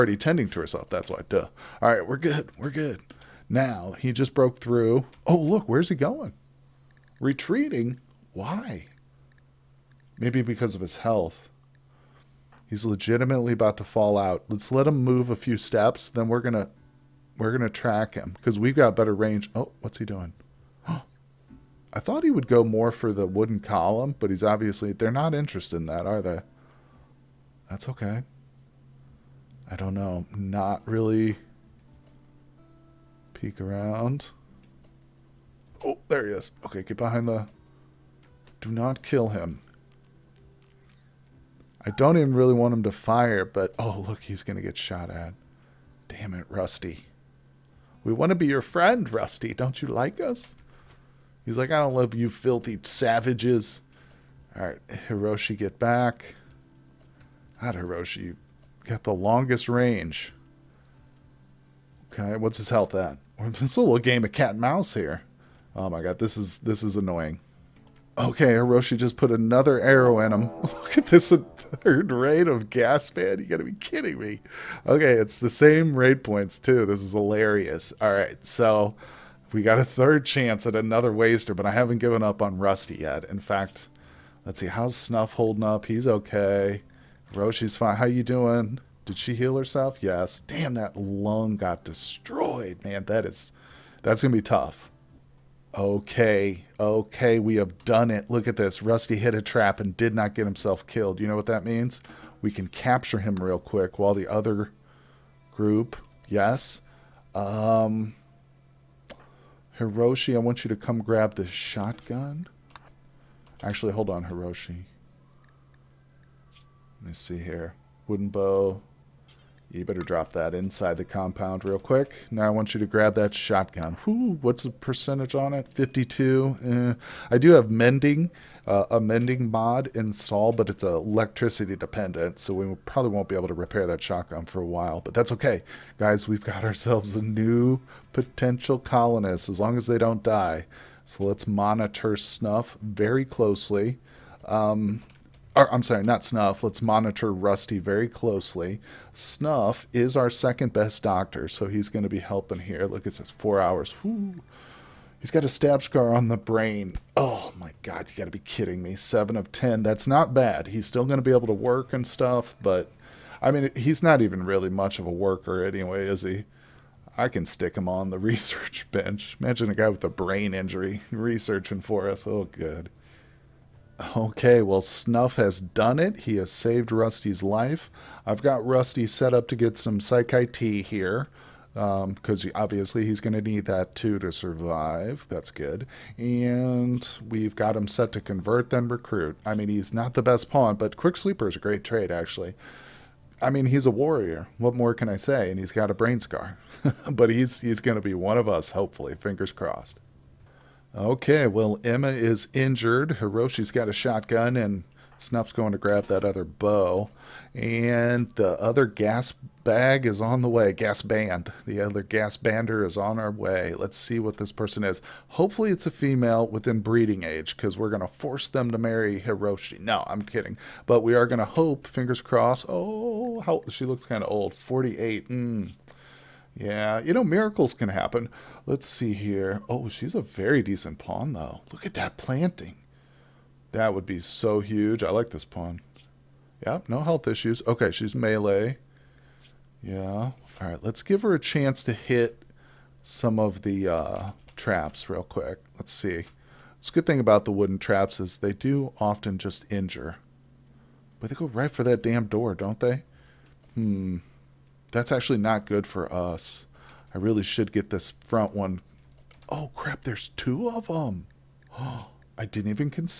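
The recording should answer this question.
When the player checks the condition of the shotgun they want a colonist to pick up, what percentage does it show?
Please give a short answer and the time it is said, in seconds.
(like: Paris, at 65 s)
52, at 125 s.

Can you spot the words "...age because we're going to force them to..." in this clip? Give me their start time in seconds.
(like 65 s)
217 s.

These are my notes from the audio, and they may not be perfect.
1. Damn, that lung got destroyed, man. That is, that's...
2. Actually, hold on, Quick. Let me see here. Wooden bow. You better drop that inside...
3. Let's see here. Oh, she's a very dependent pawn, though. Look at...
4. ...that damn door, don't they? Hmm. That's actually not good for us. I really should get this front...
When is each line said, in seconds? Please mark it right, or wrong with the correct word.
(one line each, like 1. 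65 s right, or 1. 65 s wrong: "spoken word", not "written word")
1. 90 s right
2. 113 s wrong: "Hiroshi", not "Quick"
3. 228 s wrong: "decent", not "dependent"
4. 251 s right.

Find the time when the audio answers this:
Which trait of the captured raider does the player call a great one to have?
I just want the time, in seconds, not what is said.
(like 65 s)
190 s.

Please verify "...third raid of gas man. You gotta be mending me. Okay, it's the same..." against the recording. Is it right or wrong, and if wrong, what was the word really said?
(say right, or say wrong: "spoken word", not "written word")
wrong: "kidding", not "mending".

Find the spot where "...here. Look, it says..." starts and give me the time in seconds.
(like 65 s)
152 s.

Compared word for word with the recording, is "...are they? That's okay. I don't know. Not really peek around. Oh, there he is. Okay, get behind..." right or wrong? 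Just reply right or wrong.
right.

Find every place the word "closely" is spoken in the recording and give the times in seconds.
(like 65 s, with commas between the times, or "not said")
143 s, 148 s.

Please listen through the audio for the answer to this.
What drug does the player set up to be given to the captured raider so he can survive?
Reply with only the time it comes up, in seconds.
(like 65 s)
179 s.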